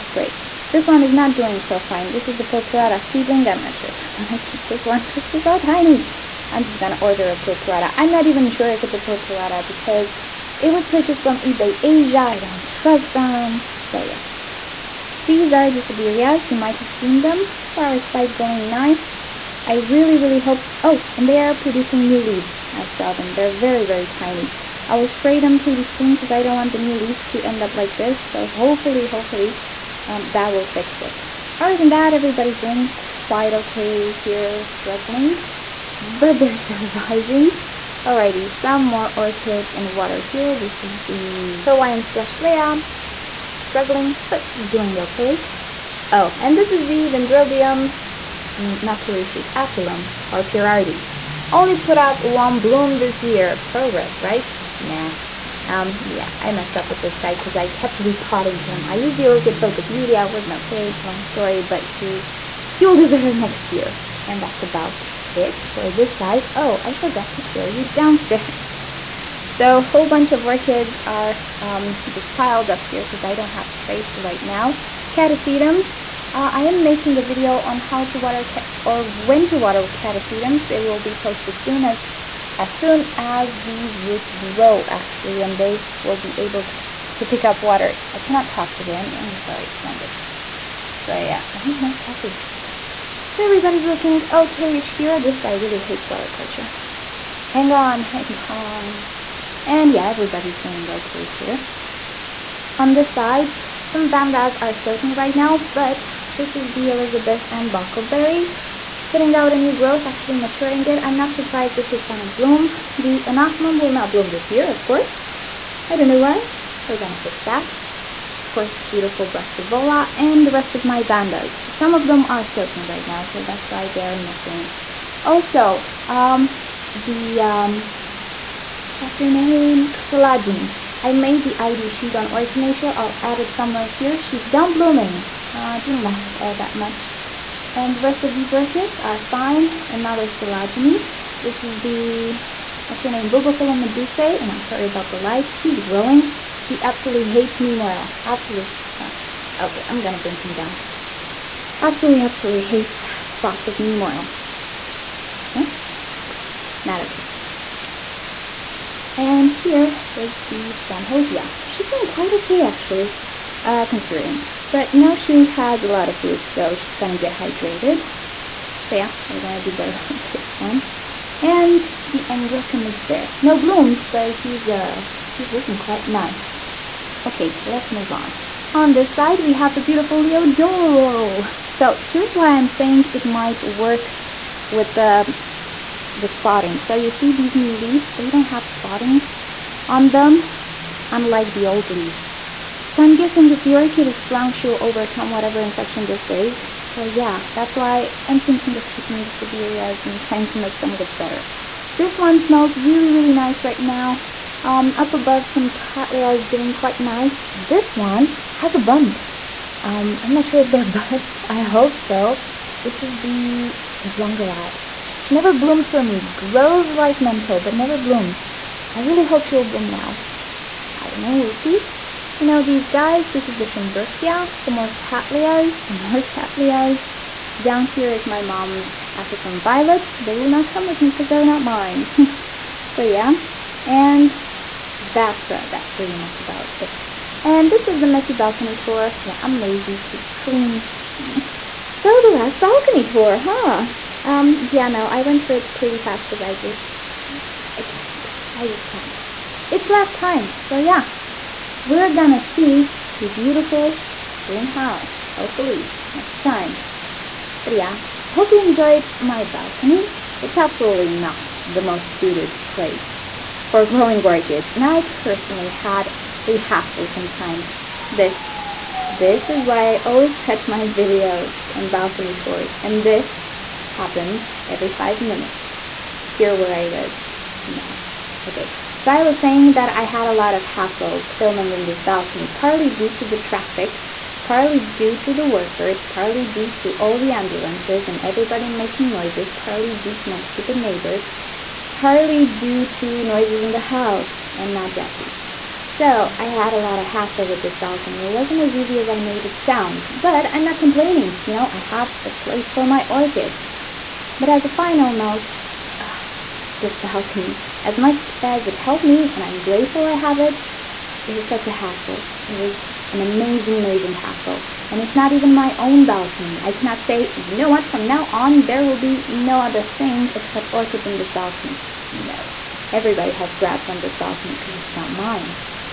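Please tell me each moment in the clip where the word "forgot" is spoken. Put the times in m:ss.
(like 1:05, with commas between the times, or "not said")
1:06.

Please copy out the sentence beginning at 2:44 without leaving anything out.
But now she has a lot of roots, so she's gonna get hydrated.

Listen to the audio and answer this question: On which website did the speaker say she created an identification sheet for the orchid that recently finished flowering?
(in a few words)
Orchid Nature.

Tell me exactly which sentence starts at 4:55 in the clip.
So, I had a lot of hassle with this balcony.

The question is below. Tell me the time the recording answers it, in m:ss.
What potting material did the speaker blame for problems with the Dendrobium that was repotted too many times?
0:59.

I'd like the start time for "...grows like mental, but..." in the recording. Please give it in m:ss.
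3:36.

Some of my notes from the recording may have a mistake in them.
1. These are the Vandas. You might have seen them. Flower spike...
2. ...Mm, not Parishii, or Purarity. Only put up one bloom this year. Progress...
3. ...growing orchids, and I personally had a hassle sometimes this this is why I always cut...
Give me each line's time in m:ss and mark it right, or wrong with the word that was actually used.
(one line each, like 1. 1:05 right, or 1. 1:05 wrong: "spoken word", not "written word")
1. 0:15 wrong: "Sedireas", not "Vandas"
2. 0:48 right
3. 4:23 right.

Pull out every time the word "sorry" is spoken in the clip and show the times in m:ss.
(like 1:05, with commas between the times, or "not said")
1:29, 2:24.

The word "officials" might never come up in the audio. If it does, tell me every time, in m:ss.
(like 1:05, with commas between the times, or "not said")
not said.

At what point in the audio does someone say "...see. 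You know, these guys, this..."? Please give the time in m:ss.
3:41.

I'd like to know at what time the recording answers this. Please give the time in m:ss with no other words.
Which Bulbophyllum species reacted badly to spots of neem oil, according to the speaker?
2:23.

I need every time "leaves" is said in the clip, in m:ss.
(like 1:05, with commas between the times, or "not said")
0:22, 0:26, 3:07, 3:11.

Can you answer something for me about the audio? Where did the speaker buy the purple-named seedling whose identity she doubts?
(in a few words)
eBay Asia.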